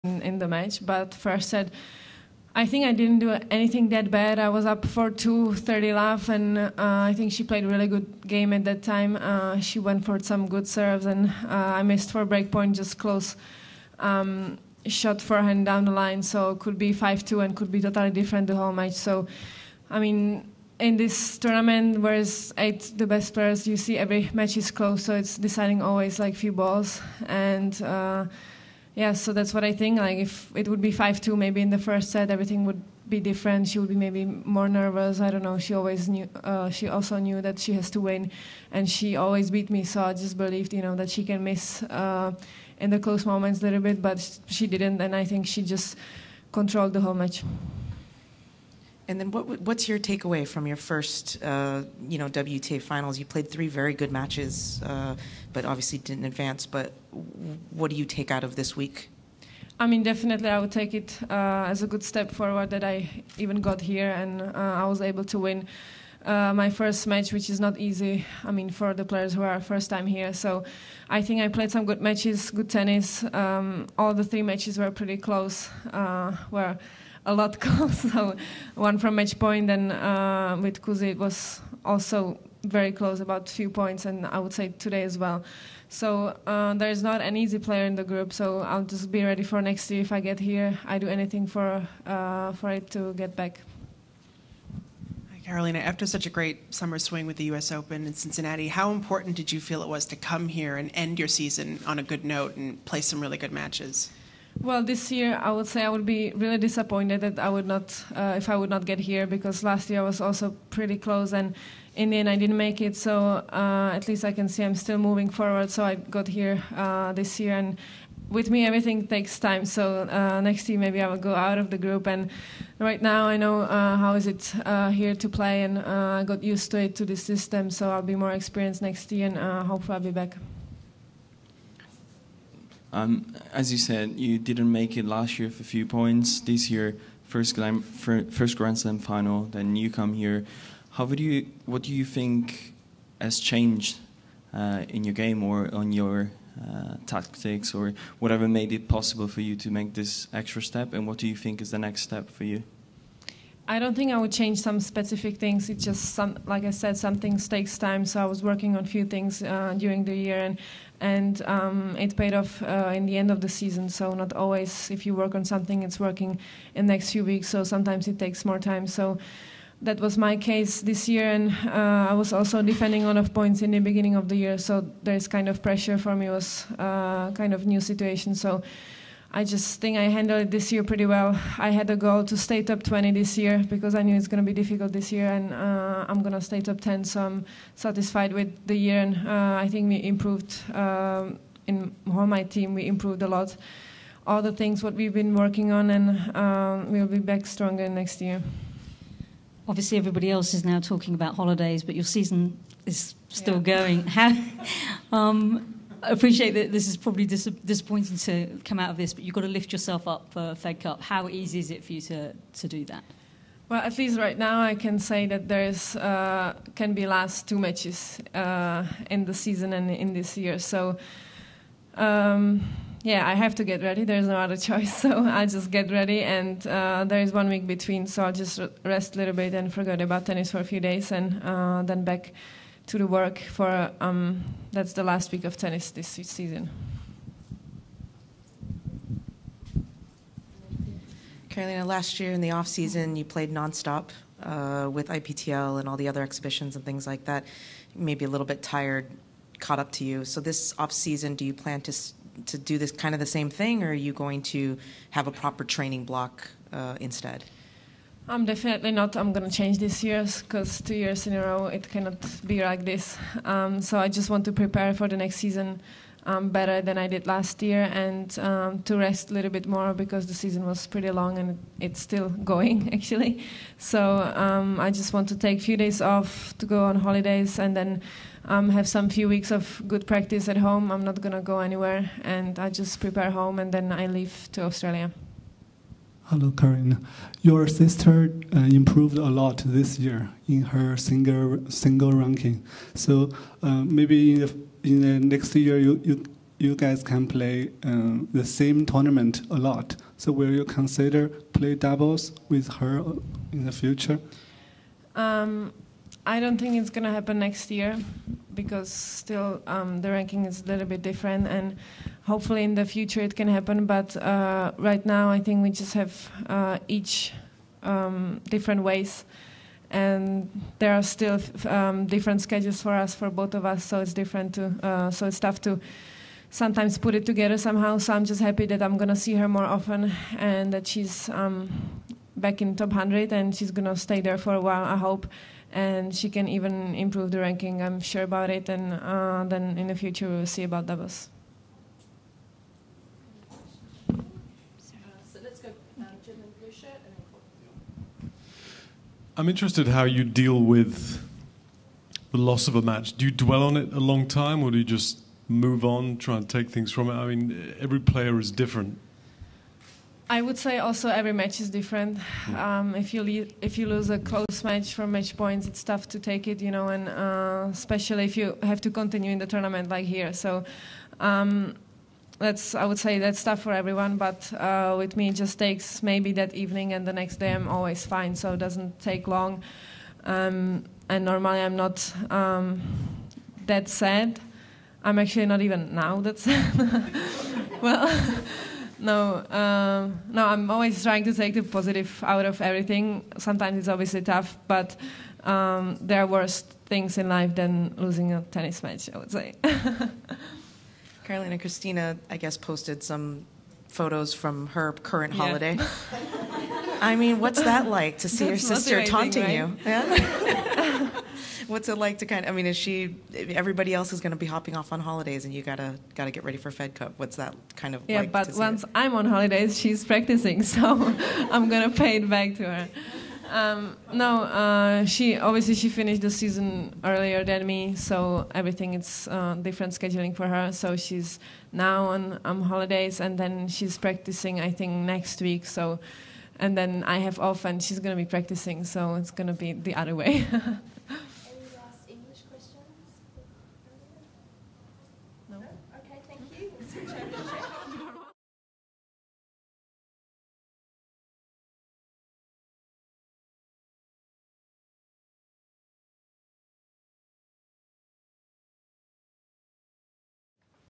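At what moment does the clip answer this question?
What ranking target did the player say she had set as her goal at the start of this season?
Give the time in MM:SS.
03:02.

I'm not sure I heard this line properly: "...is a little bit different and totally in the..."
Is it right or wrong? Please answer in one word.
wrong.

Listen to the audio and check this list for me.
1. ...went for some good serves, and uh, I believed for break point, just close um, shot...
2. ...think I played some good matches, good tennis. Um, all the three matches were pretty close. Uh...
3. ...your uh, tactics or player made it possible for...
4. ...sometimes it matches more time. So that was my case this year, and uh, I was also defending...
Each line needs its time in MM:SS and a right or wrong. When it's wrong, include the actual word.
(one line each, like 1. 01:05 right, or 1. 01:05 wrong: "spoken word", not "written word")
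1. 00:09 wrong: "missed", not "believed"
2. 01:11 right
3. 02:25 wrong: "whatever", not "player"
4. 02:47 wrong: "takes", not "matches".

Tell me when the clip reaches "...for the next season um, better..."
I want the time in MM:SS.
04:24.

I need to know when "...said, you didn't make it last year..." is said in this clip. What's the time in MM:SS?
02:13.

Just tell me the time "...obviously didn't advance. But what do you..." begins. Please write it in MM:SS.
00:55.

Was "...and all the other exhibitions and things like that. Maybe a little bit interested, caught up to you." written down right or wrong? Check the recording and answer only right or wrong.
wrong.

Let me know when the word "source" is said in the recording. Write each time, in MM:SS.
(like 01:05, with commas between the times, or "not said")
not said.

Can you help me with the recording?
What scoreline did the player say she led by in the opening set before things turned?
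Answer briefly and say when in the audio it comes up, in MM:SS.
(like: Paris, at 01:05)
2-30 love, at 00:05.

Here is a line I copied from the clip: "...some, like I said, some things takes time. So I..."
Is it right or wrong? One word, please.
right.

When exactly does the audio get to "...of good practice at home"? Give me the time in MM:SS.
04:39.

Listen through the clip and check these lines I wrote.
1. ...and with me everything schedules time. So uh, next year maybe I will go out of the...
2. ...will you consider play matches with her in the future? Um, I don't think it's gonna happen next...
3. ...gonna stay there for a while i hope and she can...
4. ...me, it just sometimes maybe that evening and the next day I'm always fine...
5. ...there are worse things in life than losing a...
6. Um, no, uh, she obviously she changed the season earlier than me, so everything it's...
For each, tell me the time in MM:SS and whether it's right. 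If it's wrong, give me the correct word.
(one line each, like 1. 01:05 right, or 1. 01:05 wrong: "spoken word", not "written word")
1. 01:57 wrong: "takes", not "schedules"
2. 05:00 wrong: "doubles", not "matches"
3. 05:33 right
4. 06:15 wrong: "takes", not "sometimes"
5. 06:35 right
6. 07:03 wrong: "finished", not "changed".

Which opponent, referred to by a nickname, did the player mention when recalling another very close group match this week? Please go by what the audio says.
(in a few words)
Kuzi.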